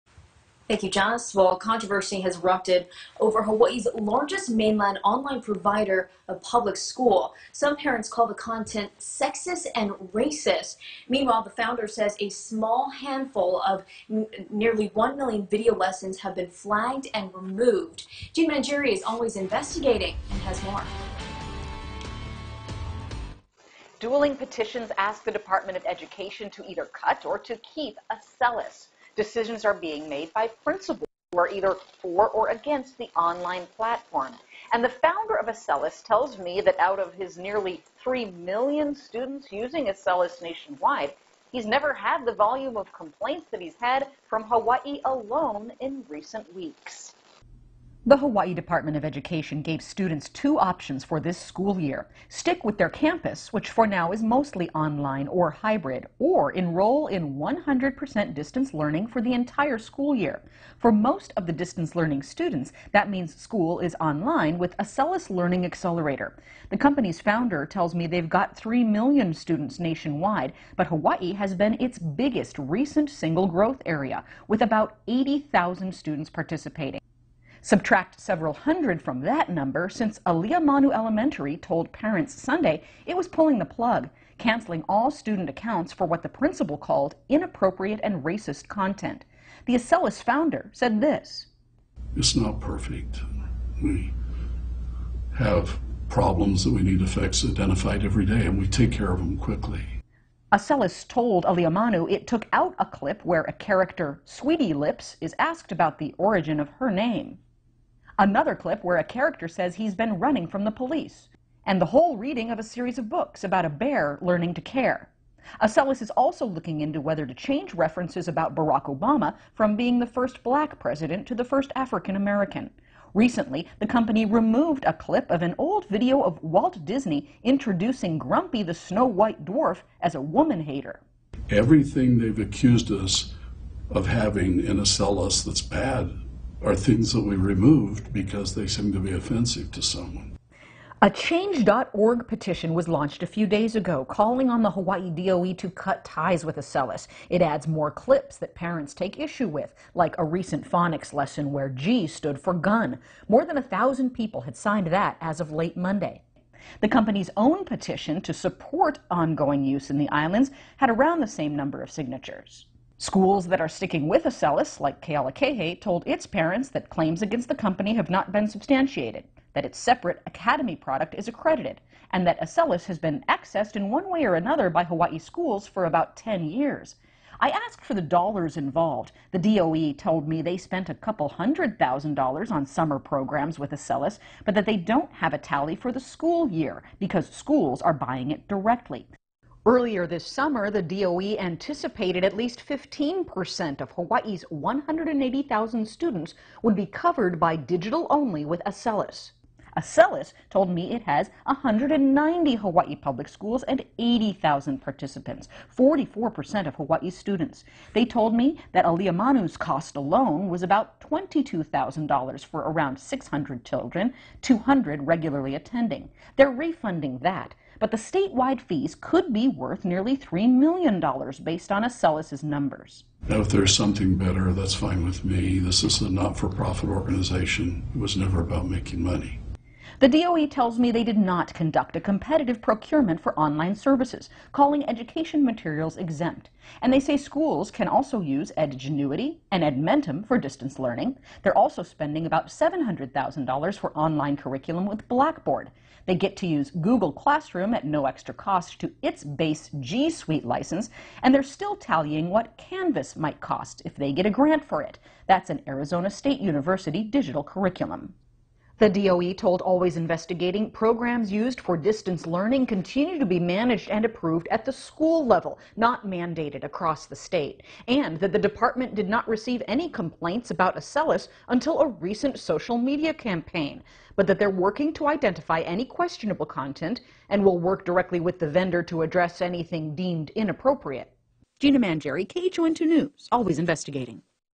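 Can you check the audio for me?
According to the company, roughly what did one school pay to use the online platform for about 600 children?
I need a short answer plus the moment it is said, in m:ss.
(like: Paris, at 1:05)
$22,000, at 3:31.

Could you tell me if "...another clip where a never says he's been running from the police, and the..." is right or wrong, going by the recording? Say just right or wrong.
wrong.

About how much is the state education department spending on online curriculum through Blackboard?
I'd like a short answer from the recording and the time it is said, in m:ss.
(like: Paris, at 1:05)
$700,000, at 4:02.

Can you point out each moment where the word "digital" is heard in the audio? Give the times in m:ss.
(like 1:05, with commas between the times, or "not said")
3:17, 4:17.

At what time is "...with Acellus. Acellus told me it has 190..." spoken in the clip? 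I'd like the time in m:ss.
3:18.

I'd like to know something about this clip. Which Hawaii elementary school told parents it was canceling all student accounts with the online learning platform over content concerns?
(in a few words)
Aliamanu Elementary.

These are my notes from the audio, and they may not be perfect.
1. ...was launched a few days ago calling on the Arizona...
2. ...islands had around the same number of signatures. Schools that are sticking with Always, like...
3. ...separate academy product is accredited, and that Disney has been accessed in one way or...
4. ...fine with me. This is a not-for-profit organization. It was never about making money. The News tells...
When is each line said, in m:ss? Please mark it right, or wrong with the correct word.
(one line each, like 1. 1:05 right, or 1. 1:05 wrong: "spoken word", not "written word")
1. 2:22 wrong: "Hawaii", not "Arizona"
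2. 2:40 wrong: "Acellus", not "Always"
3. 2:49 wrong: "Acellus", not "Disney"
4. 3:44 wrong: "DOE", not "News".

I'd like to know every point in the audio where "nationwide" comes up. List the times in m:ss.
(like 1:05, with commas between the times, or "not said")
0:40, 1:09.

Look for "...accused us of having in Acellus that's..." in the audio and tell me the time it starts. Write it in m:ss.
2:12.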